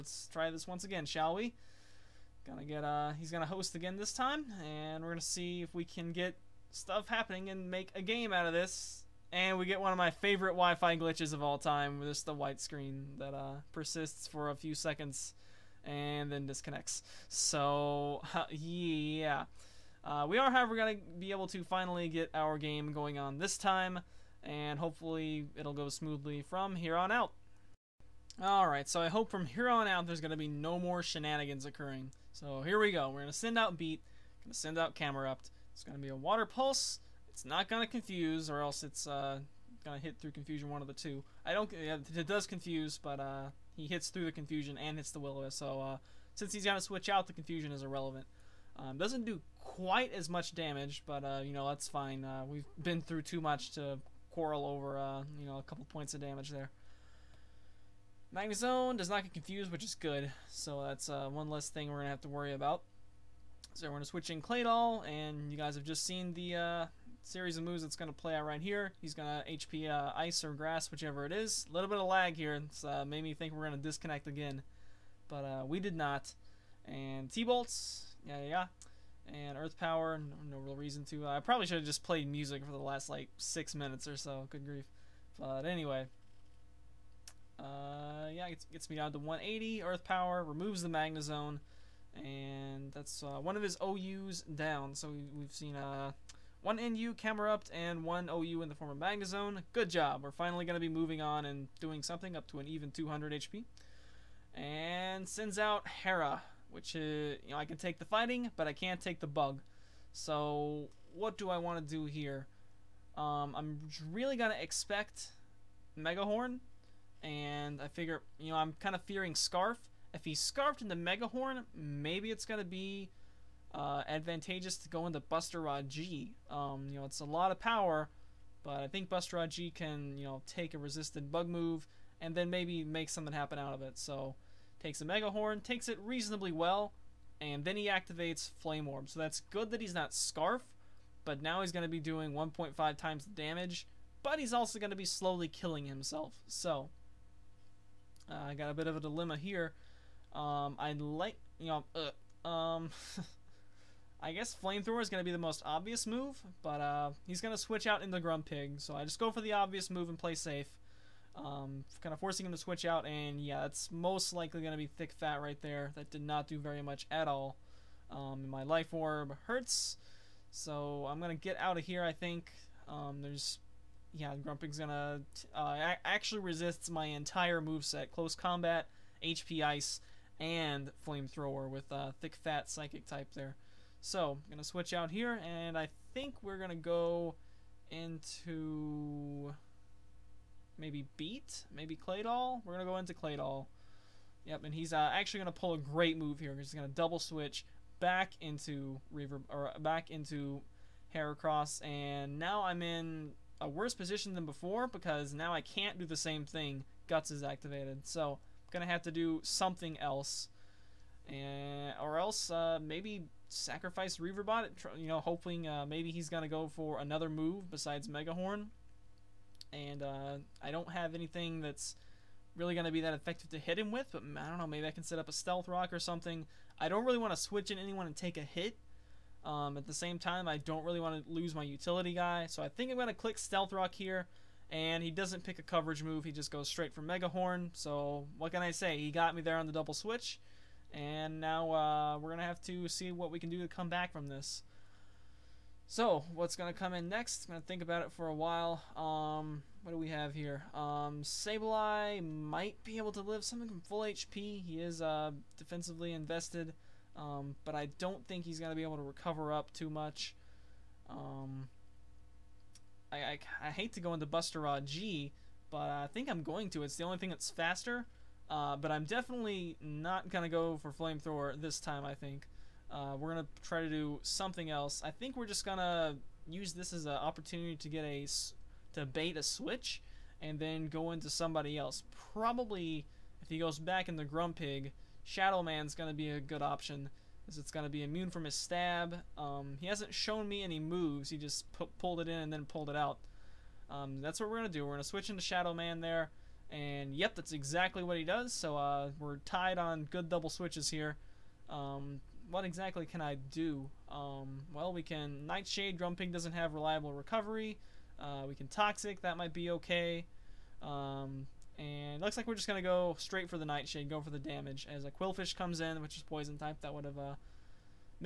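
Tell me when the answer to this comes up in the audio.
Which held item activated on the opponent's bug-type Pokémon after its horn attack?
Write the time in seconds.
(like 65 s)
138 s.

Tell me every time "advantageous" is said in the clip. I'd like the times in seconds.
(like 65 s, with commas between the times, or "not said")
124 s.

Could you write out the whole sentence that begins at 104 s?
And sends out Hera, which is, uh, you know, I can take the fighting, but I can't take the bug.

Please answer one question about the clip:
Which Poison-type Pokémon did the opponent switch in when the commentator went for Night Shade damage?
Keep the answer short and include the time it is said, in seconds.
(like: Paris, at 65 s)
Qwilfish, at 315 s.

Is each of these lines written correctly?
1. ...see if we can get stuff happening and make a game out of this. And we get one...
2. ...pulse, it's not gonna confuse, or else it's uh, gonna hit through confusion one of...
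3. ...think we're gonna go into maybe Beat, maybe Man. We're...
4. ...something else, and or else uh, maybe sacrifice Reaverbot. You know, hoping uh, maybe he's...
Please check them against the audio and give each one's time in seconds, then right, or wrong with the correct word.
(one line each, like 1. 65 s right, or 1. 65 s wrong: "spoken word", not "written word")
1. 5 s right
2. 36 s right
3. 186 s wrong: "Claydol", not "Man"
4. 209 s right.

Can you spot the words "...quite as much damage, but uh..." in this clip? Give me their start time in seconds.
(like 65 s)
49 s.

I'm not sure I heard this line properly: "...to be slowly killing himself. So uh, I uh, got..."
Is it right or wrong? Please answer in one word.
right.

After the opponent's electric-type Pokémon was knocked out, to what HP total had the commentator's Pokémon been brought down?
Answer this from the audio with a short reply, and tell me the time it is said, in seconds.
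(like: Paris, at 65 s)
180, at 89 s.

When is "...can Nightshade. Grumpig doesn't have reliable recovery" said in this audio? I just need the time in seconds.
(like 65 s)
305 s.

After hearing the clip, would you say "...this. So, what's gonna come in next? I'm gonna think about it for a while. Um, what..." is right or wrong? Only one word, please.
right.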